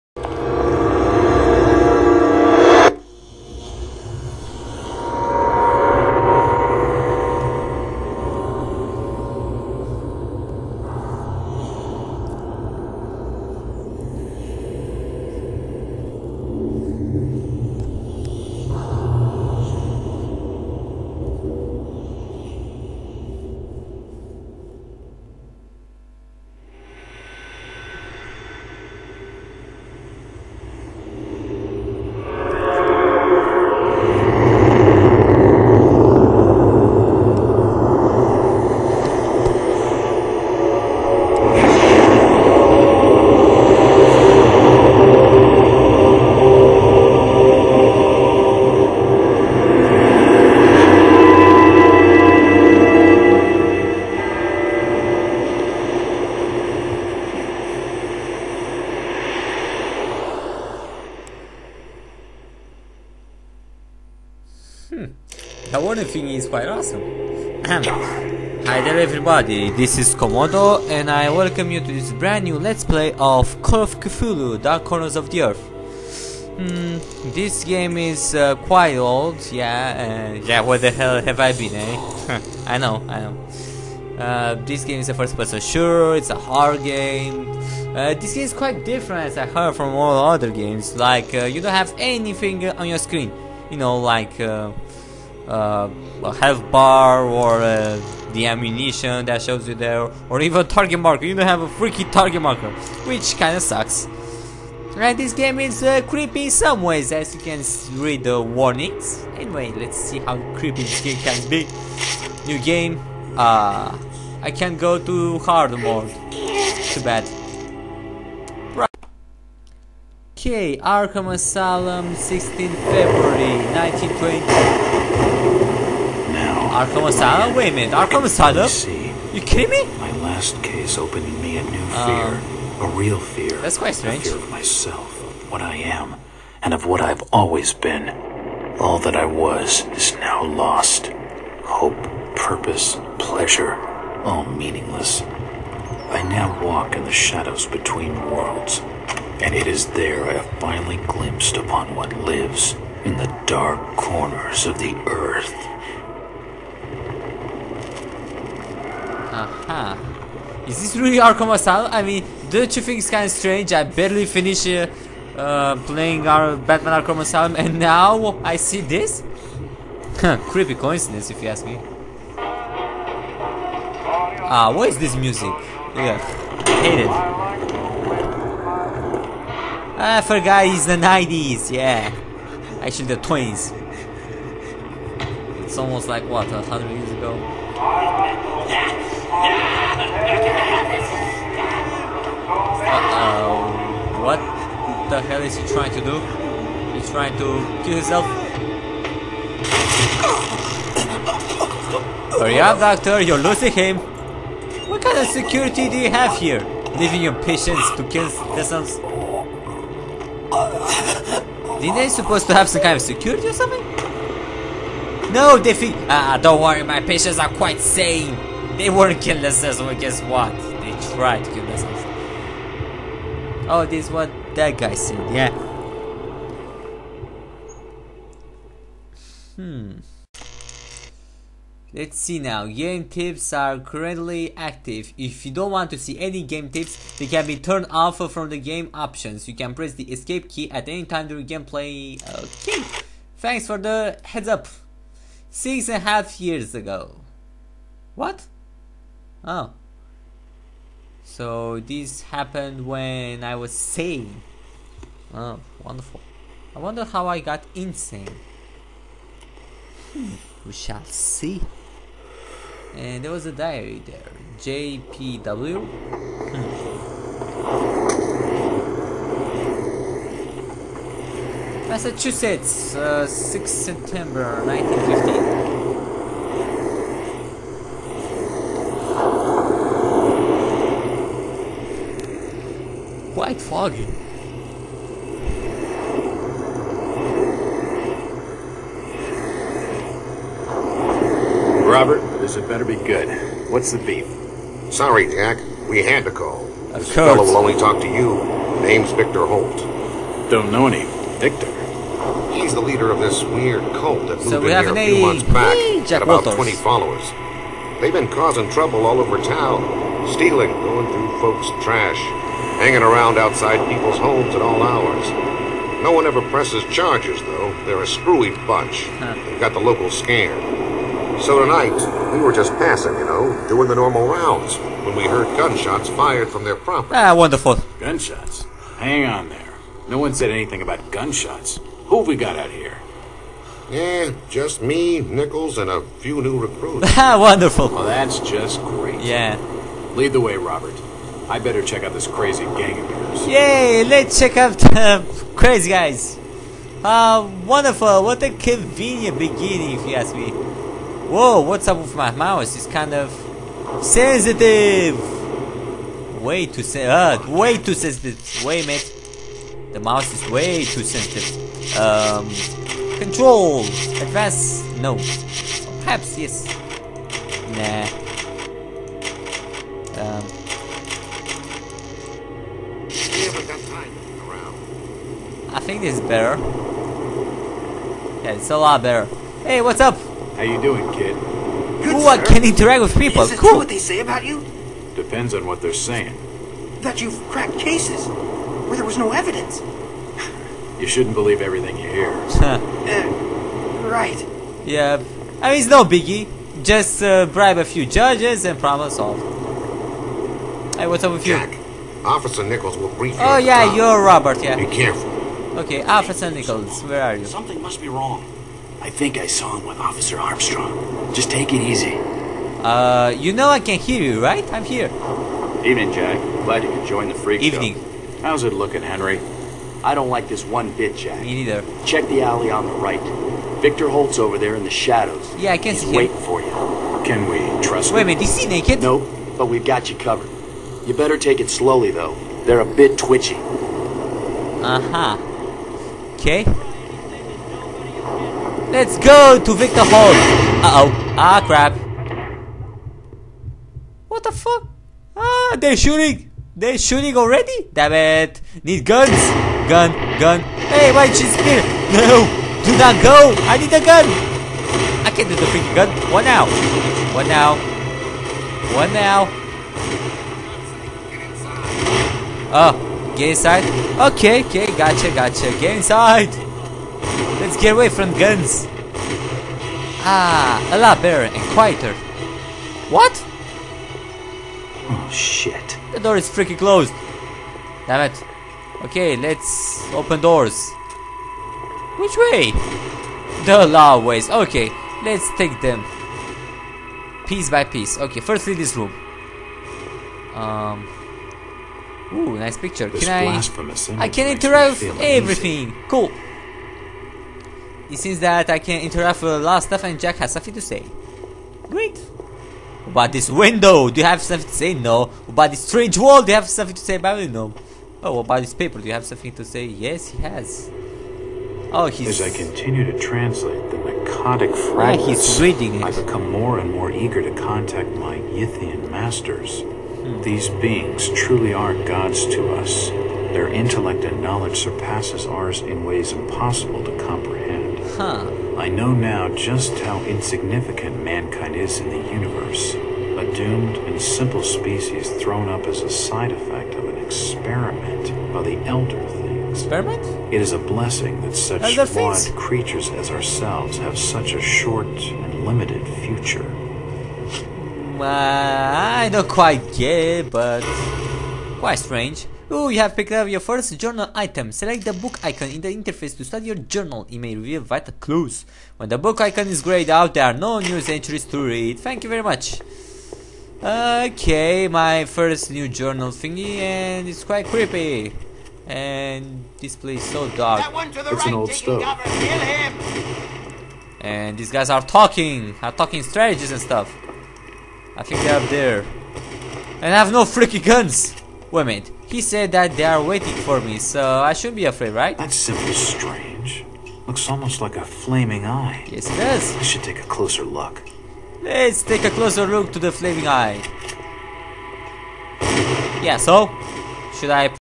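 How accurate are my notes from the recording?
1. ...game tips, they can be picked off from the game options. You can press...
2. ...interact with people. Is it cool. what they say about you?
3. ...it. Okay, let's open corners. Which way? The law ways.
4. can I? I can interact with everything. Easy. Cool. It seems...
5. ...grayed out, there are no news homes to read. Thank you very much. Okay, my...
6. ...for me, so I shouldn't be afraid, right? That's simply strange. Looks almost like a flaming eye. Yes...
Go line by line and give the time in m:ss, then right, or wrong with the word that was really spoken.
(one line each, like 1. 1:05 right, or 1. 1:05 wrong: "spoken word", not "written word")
1. 3:56 wrong: "turned", not "picked"
2. 6:22 right
3. 7:58 wrong: "doors", not "corners"
4. 8:13 right
5. 9:19 wrong: "entries", not "homes"
6. 9:43 right.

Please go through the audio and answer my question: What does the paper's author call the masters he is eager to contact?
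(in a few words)
Yithian.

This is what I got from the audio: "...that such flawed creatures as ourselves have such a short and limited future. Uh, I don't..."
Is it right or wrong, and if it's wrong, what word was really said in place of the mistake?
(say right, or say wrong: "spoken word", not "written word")
right.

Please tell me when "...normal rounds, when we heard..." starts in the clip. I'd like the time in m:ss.
5:23.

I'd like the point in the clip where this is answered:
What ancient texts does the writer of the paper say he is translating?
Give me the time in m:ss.
8:33.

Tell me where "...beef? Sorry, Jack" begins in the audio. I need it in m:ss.
4:53.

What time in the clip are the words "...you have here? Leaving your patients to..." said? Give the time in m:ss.
3:25.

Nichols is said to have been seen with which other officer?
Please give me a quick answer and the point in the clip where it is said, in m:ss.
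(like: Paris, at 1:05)
Officer Armstrong, at 6:49.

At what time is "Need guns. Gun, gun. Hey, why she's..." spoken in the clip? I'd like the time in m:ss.
7:28.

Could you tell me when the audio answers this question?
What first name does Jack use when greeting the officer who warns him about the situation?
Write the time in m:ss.
6:59.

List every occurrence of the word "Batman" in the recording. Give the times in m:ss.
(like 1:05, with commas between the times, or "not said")
2:46.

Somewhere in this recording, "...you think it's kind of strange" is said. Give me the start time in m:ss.
2:42.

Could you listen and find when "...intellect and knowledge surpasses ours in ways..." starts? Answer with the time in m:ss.
8:43.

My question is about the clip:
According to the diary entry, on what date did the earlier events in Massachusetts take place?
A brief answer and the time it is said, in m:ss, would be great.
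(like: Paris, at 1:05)
6 September 1915, at 4:33.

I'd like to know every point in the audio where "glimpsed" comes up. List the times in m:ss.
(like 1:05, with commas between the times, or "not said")
2:31.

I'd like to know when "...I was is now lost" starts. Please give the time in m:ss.
2:19.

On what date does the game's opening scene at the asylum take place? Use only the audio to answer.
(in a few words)
16 February 1920.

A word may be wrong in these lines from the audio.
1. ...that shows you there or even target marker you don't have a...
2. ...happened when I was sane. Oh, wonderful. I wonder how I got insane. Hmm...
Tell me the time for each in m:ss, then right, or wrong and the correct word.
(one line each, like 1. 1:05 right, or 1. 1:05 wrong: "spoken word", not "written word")
1. 1:39 right
2. 4:12 right.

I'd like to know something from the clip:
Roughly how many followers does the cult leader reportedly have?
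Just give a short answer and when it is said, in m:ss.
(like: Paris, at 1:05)
20, at 5:06.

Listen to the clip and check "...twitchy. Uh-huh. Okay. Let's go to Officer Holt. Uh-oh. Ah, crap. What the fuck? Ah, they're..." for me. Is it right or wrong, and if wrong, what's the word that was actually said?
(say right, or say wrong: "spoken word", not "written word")
wrong: "Victor", not "Officer".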